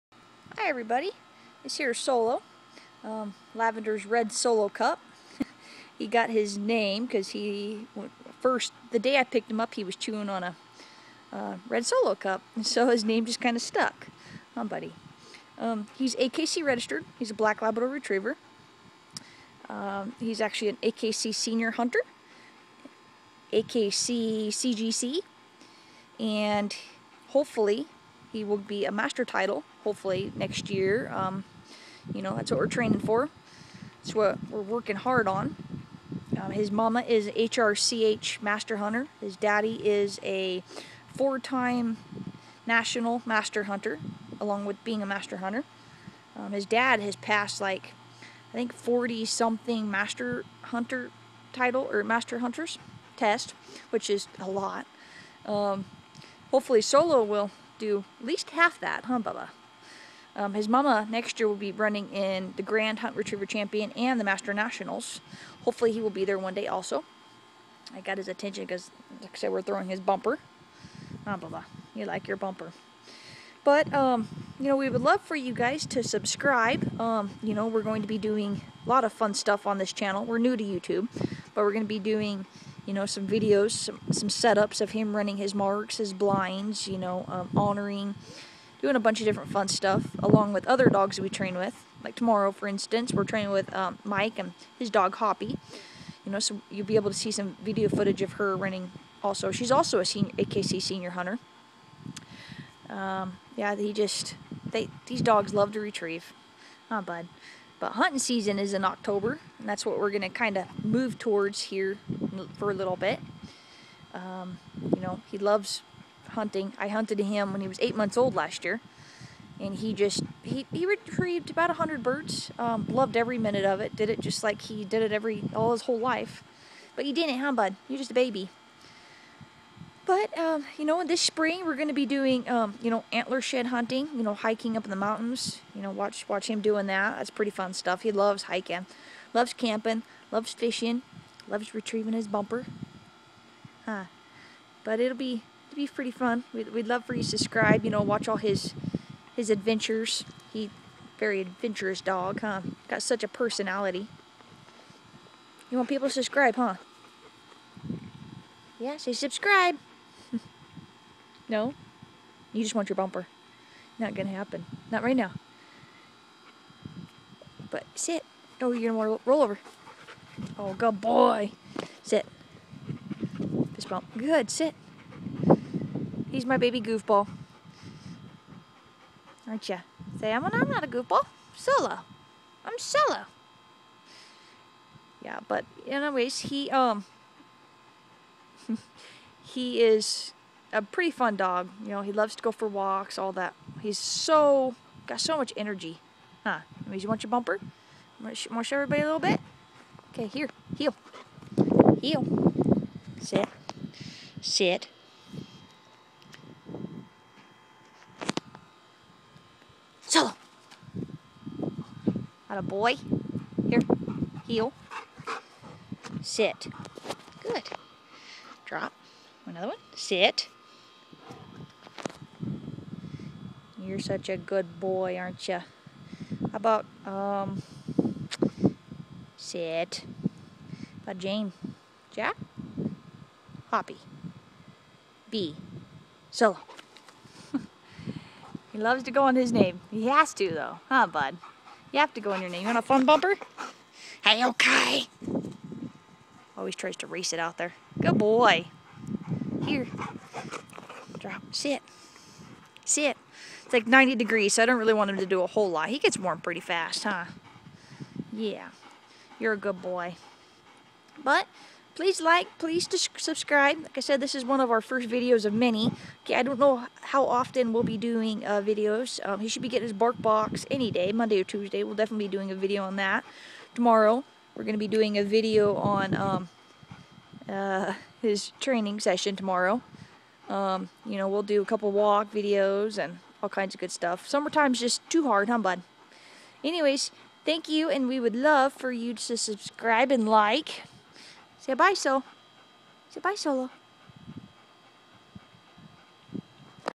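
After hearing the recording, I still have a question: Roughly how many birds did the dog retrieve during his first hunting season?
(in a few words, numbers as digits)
100.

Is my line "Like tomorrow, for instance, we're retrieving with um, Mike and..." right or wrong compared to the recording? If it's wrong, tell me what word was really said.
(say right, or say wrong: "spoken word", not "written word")
wrong: "training", not "retrieving".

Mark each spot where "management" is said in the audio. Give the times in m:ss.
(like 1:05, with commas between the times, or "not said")
not said.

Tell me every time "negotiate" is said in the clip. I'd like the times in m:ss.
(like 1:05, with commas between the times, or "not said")
not said.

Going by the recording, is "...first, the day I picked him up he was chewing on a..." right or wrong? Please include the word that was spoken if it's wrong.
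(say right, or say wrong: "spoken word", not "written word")
right.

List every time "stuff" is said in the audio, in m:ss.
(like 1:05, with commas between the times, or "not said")
1:19, 1:29, 2:17, 4:43.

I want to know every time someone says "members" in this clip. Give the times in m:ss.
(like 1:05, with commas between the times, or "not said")
not said.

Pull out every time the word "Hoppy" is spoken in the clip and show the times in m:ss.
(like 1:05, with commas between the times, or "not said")
1:35, 3:53.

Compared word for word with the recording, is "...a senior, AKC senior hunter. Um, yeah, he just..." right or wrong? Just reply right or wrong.
right.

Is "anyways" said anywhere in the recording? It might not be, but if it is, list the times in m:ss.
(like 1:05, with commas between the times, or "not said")
3:05, 4:46.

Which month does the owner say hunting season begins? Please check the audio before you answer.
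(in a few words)
October.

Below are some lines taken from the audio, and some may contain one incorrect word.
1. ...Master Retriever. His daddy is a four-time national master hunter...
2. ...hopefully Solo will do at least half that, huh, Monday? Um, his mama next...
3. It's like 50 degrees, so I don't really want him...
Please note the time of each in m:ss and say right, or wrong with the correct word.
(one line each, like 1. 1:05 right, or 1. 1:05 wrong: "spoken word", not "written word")
1. 0:38 wrong: "Hunter", not "Retriever"
2. 0:56 wrong: "Bubba", not "Monday"
3. 4:13 wrong: "90", not "50".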